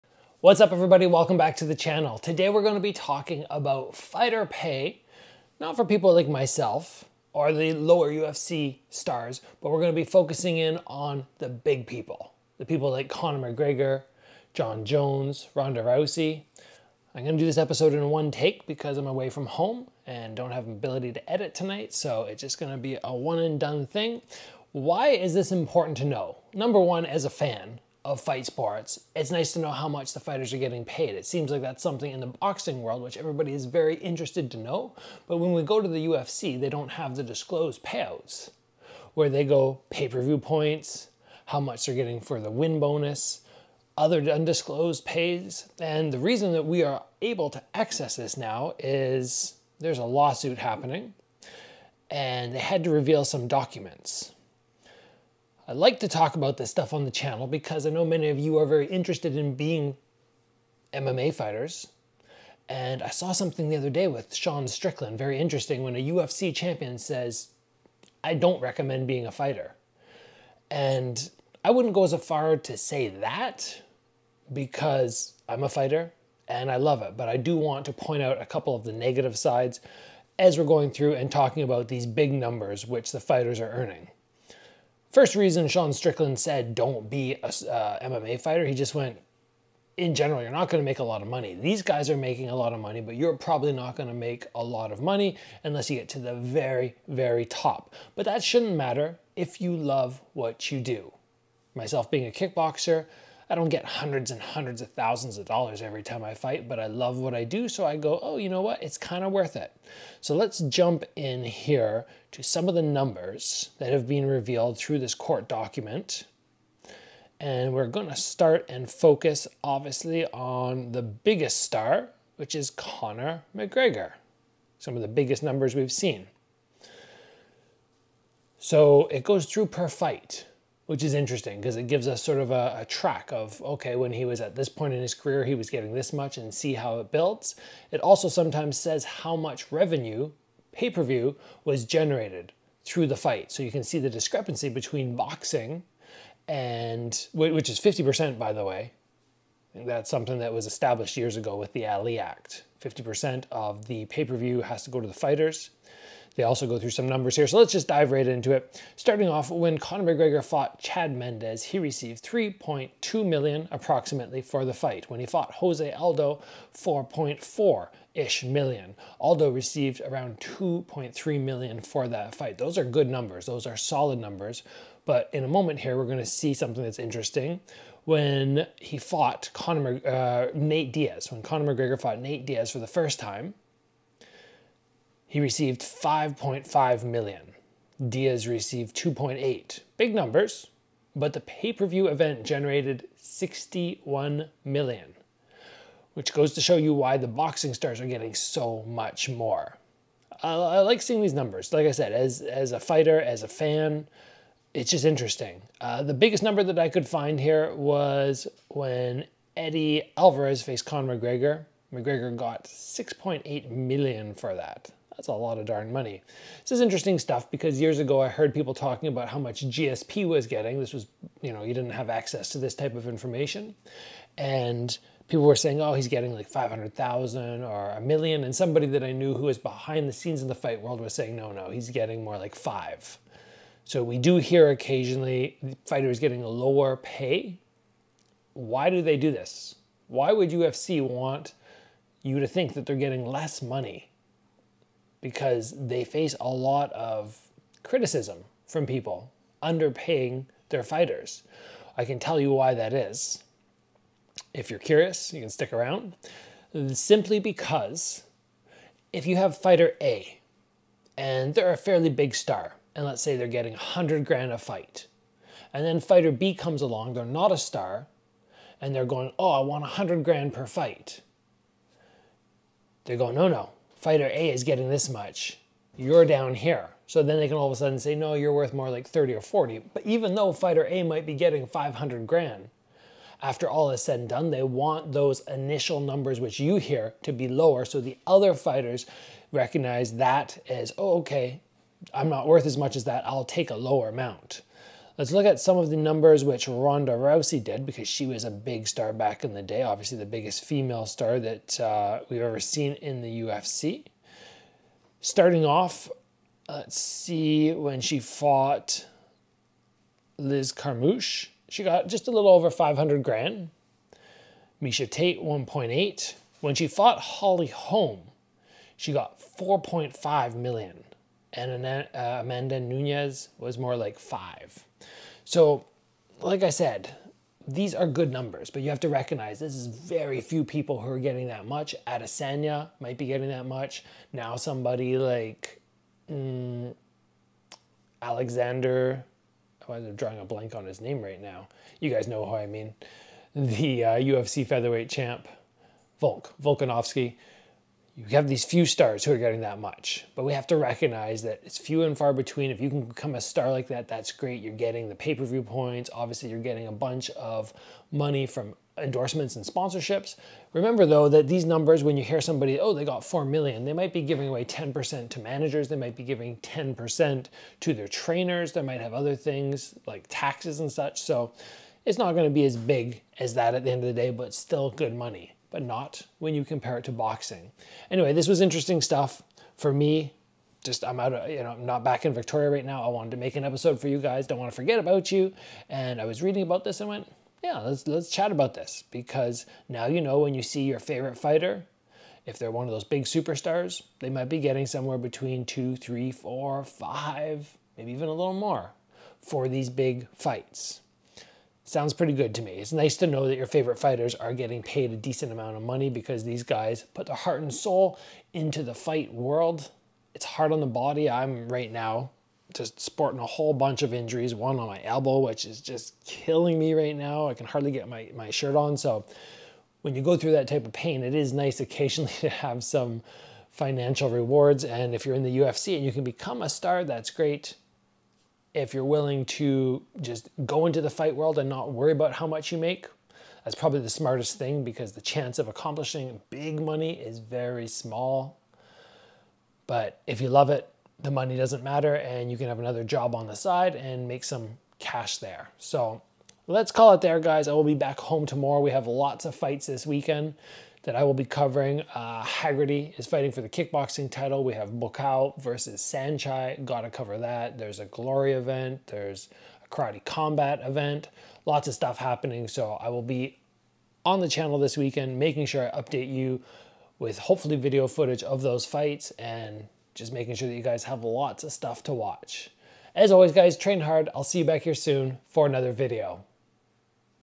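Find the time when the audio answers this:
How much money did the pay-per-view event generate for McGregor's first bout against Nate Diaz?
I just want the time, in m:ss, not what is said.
3:13.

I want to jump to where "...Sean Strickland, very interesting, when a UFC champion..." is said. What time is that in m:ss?
1:04.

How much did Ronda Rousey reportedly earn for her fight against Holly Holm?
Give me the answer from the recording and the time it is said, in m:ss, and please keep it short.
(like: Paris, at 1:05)
4.5 million, at 5:19.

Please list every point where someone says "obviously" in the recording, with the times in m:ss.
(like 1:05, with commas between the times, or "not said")
1:59, 4:59, 5:56.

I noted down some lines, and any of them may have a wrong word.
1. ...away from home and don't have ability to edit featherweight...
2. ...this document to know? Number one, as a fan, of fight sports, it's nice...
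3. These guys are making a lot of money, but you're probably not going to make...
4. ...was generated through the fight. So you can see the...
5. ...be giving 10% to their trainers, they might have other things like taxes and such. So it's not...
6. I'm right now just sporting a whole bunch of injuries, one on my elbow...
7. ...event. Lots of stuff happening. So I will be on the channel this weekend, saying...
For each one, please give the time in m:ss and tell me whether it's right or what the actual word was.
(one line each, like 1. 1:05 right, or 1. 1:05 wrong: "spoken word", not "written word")
1. 0:19 wrong: "tonight", not "featherweight"
2. 0:25 wrong: "important", not "document"
3. 1:31 right
4. 2:21 right
5. 6:06 right
6. 6:51 right
7. 7:40 wrong: "making", not "saying".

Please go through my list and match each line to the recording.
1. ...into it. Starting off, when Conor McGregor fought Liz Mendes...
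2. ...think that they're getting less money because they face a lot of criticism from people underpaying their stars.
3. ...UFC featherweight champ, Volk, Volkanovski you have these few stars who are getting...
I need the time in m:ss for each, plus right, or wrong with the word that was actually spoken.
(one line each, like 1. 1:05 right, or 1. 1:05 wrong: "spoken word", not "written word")
1. 2:38 wrong: "Chad", not "Liz"
2. 4:02 wrong: "fighters", not "stars"
3. 5:44 right.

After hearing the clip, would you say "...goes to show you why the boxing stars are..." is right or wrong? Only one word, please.
right.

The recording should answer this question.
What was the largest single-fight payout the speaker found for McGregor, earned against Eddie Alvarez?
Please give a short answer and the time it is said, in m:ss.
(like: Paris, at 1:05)
6.8 million, at 3:32.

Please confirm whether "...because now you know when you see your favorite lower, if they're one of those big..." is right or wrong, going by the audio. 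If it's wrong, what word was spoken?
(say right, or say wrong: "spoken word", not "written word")
wrong: "fighter", not "lower".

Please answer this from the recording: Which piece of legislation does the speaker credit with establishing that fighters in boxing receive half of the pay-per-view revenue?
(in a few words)
Ali Act.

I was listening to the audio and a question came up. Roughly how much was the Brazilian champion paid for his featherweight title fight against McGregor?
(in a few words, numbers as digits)
2.3 million.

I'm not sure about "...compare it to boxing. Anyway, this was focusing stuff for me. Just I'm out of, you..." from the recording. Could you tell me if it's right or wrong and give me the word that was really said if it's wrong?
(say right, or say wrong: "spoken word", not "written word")
wrong: "interesting", not "focusing".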